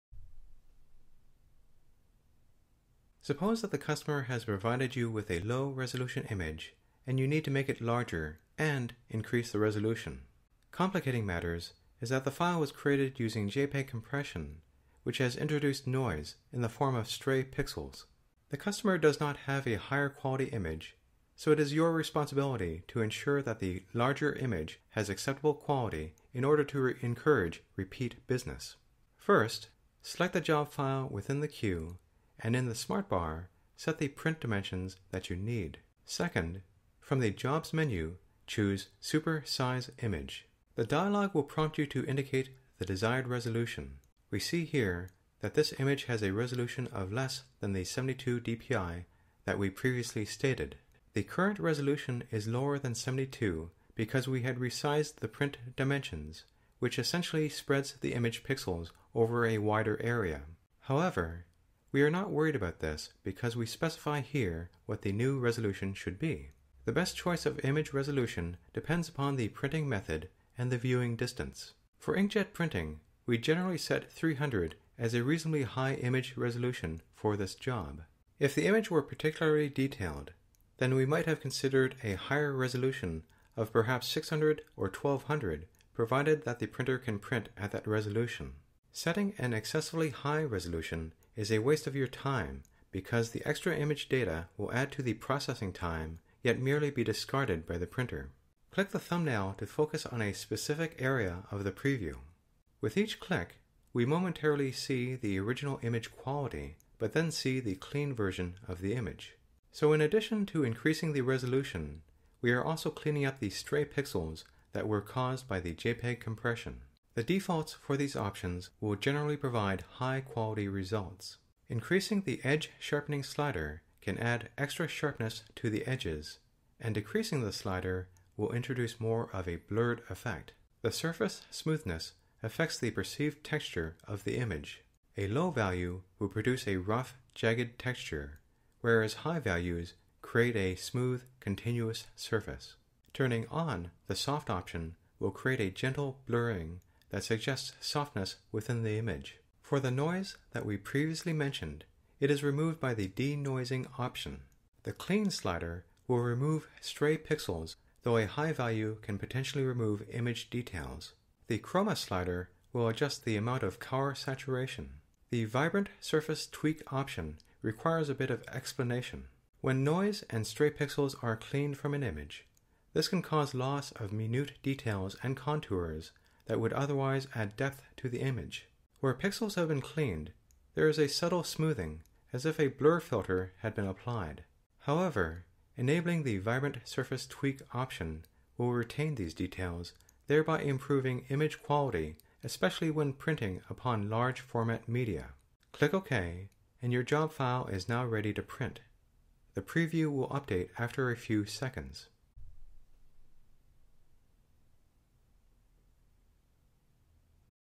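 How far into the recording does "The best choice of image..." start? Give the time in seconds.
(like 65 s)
66 s.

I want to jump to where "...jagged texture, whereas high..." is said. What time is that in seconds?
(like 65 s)
137 s.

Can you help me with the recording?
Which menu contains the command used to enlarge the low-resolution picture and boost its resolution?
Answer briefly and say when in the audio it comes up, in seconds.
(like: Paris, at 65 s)
Jobs, at 37 s.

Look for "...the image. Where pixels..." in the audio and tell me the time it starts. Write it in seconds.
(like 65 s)
178 s.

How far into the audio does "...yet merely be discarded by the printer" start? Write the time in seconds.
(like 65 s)
96 s.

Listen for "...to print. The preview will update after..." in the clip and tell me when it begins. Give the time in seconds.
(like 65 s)
198 s.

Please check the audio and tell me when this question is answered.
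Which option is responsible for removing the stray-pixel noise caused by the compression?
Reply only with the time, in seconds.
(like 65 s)
153 s.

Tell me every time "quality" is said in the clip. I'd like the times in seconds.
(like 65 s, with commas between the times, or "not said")
20 s, 25 s, 106 s, 120 s, 191 s.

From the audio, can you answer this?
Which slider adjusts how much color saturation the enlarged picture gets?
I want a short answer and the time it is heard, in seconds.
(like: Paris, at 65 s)
chroma, at 161 s.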